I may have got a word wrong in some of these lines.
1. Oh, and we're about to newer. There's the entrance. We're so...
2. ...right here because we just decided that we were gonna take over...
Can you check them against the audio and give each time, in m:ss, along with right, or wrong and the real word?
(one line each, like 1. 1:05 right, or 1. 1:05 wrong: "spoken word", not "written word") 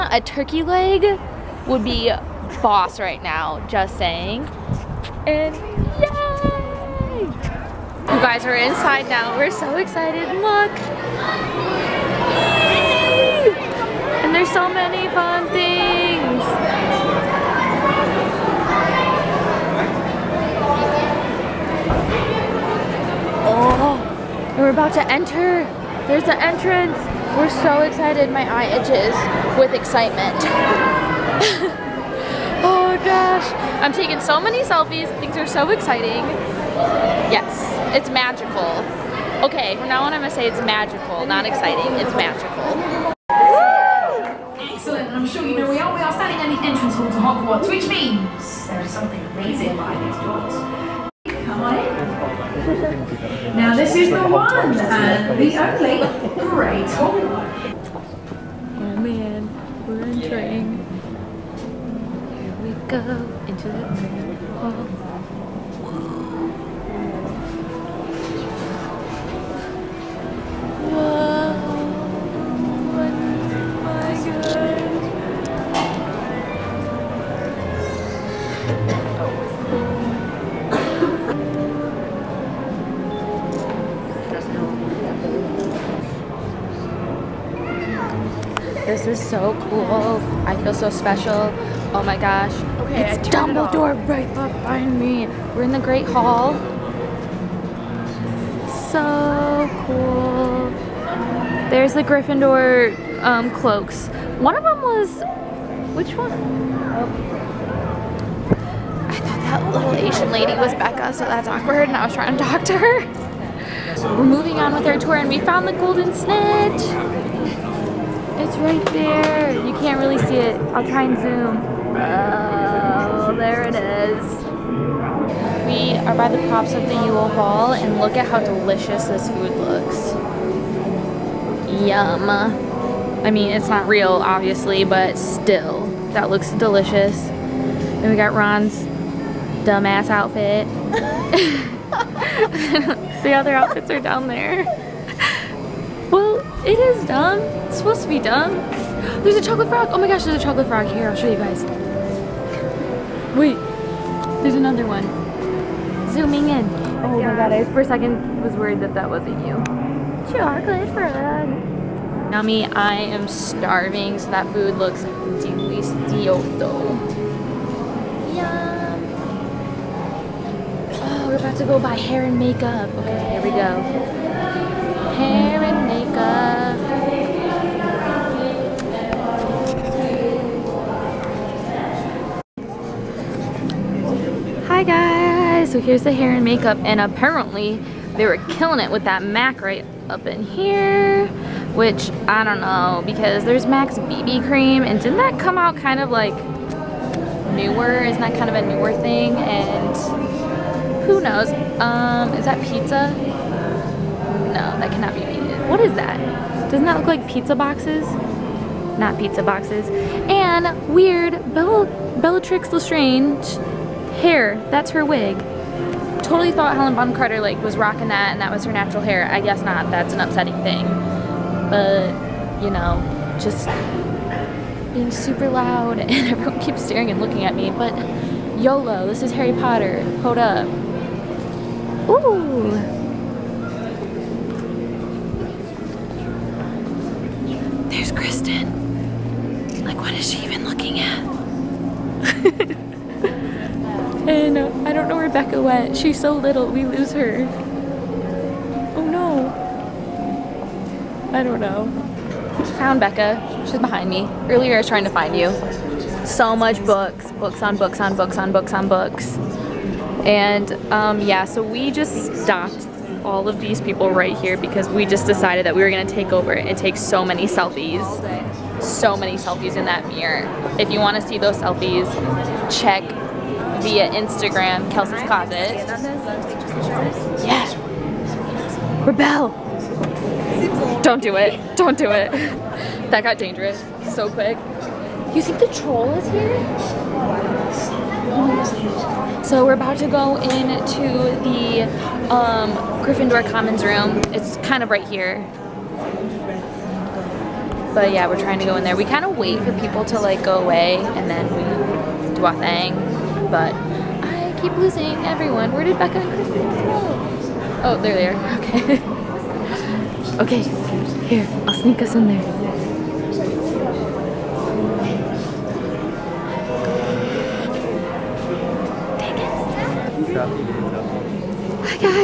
1. 0:23 wrong: "enter", not "newer"
2. 4:24 right.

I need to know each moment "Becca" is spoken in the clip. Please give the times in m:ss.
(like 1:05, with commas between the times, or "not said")
1:50, 4:05, 4:13, 5:05.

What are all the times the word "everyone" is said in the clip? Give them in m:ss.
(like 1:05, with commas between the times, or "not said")
3:46, 5:05.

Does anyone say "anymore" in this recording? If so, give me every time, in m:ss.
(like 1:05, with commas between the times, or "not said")
not said.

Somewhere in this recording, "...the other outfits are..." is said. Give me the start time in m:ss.
2:23.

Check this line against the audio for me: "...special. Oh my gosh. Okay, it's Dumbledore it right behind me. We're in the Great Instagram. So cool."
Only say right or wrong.
wrong.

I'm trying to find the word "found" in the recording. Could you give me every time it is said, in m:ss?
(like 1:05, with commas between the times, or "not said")
1:55, 4:12.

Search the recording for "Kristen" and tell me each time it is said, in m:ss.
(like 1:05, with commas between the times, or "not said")
3:58, 5:06.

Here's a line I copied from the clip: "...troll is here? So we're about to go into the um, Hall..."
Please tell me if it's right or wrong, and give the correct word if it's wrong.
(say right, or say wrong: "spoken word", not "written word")
wrong: "Gryffindor", not "Hall".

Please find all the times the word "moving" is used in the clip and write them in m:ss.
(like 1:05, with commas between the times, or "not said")
1:54.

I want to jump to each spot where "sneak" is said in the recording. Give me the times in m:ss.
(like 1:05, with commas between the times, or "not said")
5:11.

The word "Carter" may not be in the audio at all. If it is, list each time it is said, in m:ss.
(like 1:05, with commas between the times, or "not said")
3:37.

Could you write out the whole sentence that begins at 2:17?
And we got Ron's dumbass outfit.